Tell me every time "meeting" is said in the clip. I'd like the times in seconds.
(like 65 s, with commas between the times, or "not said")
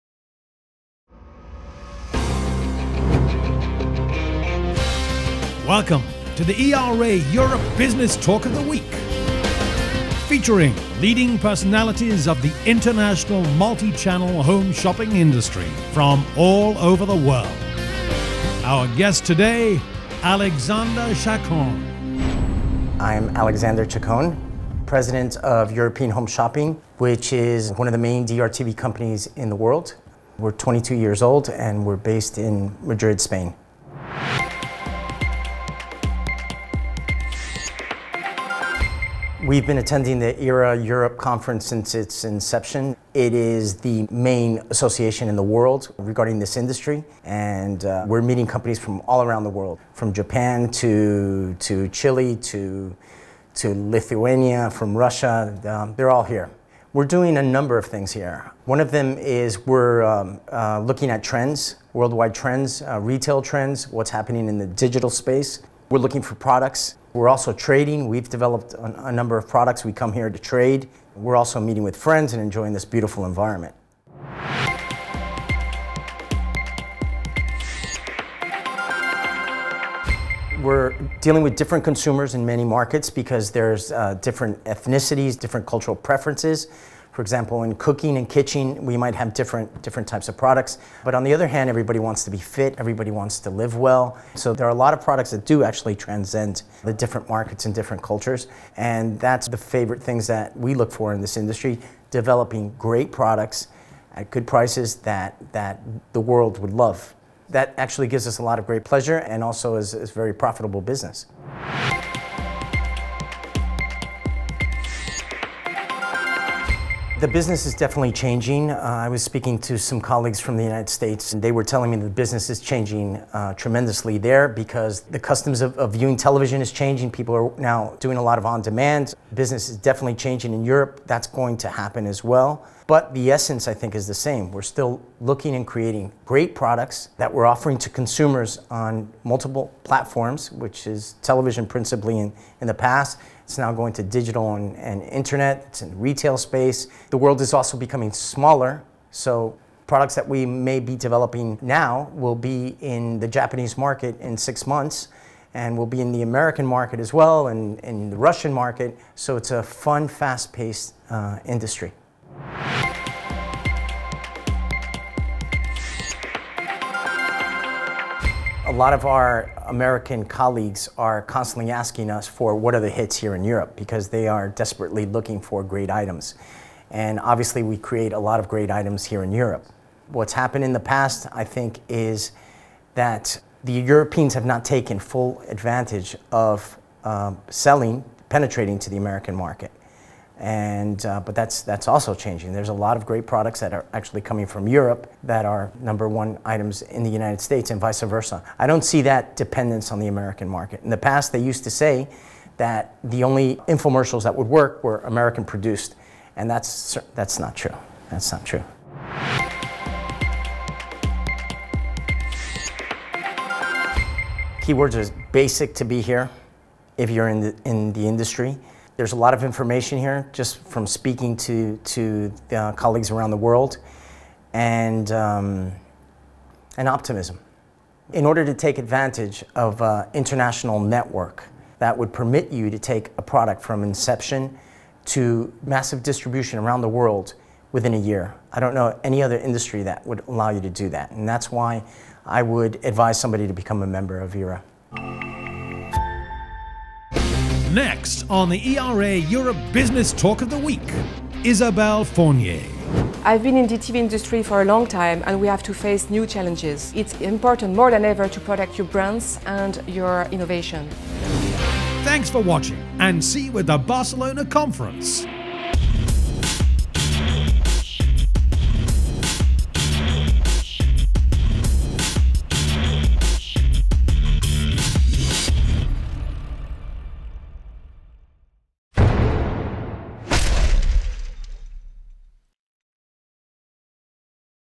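48 s, 71 s.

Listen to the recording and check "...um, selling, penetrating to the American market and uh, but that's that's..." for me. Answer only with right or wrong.
right.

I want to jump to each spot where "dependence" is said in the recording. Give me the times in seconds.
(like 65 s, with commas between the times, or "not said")
199 s.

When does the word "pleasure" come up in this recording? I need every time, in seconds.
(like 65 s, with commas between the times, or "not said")
108 s.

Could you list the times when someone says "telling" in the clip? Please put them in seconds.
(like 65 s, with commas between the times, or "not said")
121 s.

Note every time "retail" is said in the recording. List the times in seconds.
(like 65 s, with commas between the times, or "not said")
62 s, 145 s.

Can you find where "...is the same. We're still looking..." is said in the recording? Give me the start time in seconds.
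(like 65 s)
133 s.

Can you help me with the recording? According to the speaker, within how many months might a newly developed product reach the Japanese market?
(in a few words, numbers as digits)
6 months.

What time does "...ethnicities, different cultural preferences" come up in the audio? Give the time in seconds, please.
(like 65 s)
84 s.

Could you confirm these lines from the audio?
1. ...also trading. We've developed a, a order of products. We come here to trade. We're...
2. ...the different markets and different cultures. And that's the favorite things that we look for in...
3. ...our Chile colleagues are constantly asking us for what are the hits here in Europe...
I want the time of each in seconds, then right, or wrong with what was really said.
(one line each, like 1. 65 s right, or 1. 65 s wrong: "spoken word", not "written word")
1. 67 s wrong: "number", not "order"
2. 96 s right
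3. 169 s wrong: "American", not "Chile".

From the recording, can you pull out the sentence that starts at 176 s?
And obviously, we create a lot of great items here in Europe.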